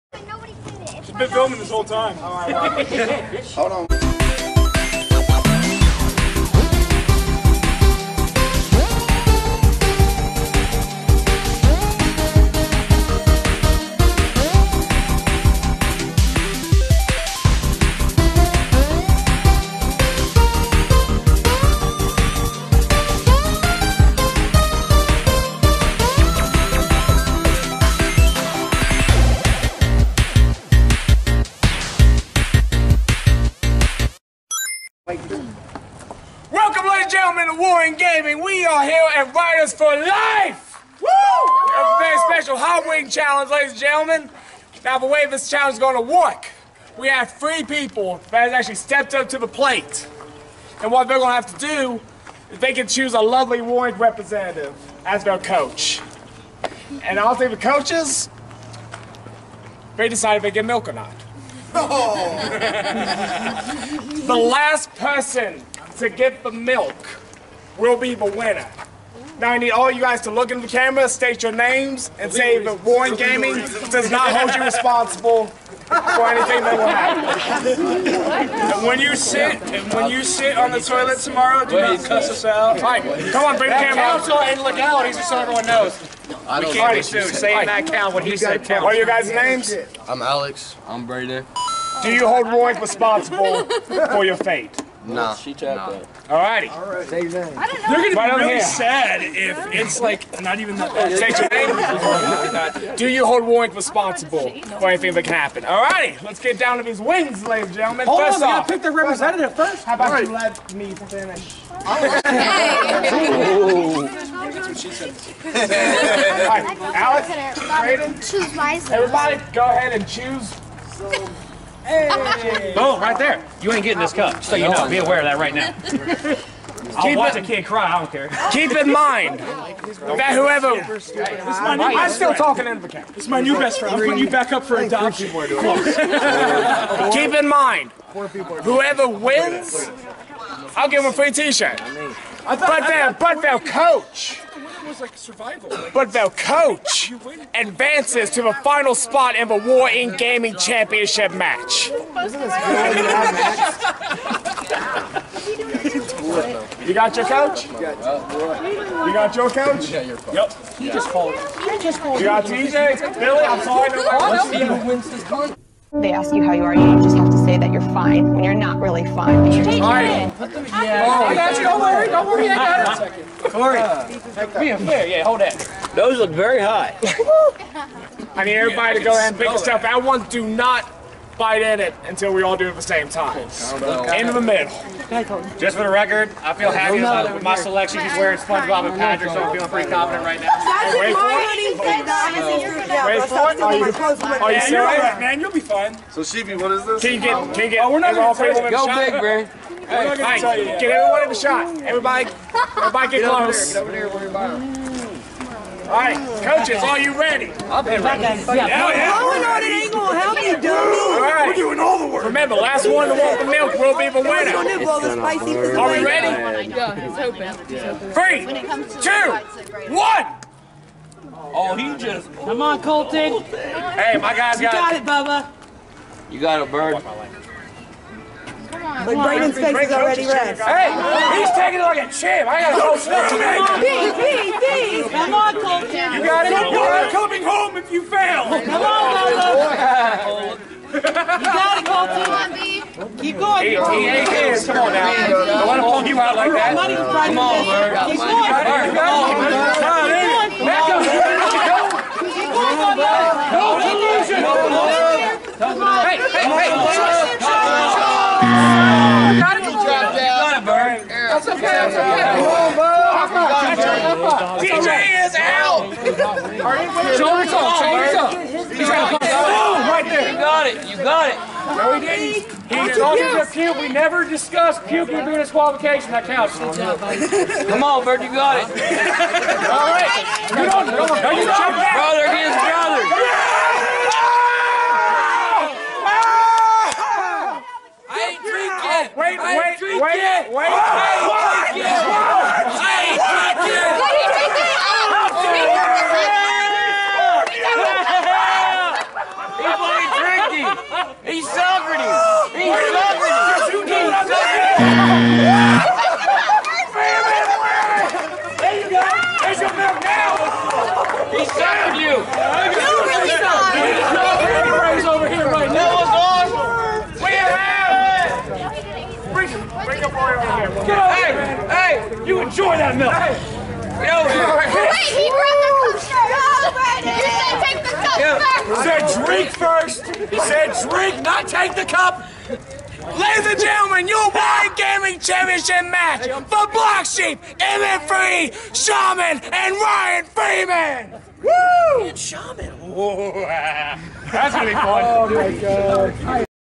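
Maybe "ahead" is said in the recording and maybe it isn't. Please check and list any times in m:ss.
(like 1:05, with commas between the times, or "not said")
1:59, 2:59.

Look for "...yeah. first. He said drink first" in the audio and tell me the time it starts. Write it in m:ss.
5:28.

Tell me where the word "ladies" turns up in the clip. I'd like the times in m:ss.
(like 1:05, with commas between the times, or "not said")
0:36, 0:43, 1:47, 5:33.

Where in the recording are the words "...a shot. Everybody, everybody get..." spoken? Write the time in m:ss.
3:21.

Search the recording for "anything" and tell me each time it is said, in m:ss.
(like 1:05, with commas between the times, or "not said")
1:16, 1:44.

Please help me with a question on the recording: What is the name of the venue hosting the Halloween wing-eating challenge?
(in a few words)
Riders for Life.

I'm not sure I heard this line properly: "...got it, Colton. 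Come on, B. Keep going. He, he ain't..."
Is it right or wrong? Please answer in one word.
right.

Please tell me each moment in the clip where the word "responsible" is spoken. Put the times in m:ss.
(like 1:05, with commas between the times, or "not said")
1:14, 1:32, 1:43.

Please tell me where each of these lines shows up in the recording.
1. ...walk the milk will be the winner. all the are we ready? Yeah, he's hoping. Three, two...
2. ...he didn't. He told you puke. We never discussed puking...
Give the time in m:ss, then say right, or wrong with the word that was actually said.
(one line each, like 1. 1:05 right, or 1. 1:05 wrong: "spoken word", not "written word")
1. 3:33 right
2. 4:31 right.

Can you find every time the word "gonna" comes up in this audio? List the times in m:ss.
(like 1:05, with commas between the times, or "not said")
1:37.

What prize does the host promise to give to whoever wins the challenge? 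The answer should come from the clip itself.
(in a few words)
A free t-shirt.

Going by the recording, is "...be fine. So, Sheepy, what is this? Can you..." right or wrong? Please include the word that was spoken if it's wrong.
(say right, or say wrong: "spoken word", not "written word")
right.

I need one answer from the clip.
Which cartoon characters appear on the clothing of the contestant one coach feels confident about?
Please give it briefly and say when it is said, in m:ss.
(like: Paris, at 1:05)
SpongeBob and Patrick, at 3:08.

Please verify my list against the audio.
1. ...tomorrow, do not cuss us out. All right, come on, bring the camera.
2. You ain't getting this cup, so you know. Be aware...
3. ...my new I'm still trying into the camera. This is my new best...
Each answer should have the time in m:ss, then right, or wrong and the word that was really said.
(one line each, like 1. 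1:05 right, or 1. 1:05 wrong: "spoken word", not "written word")
1. 1:21 right
2. 2:03 right
3. 2:11 wrong: "talking", not "trying".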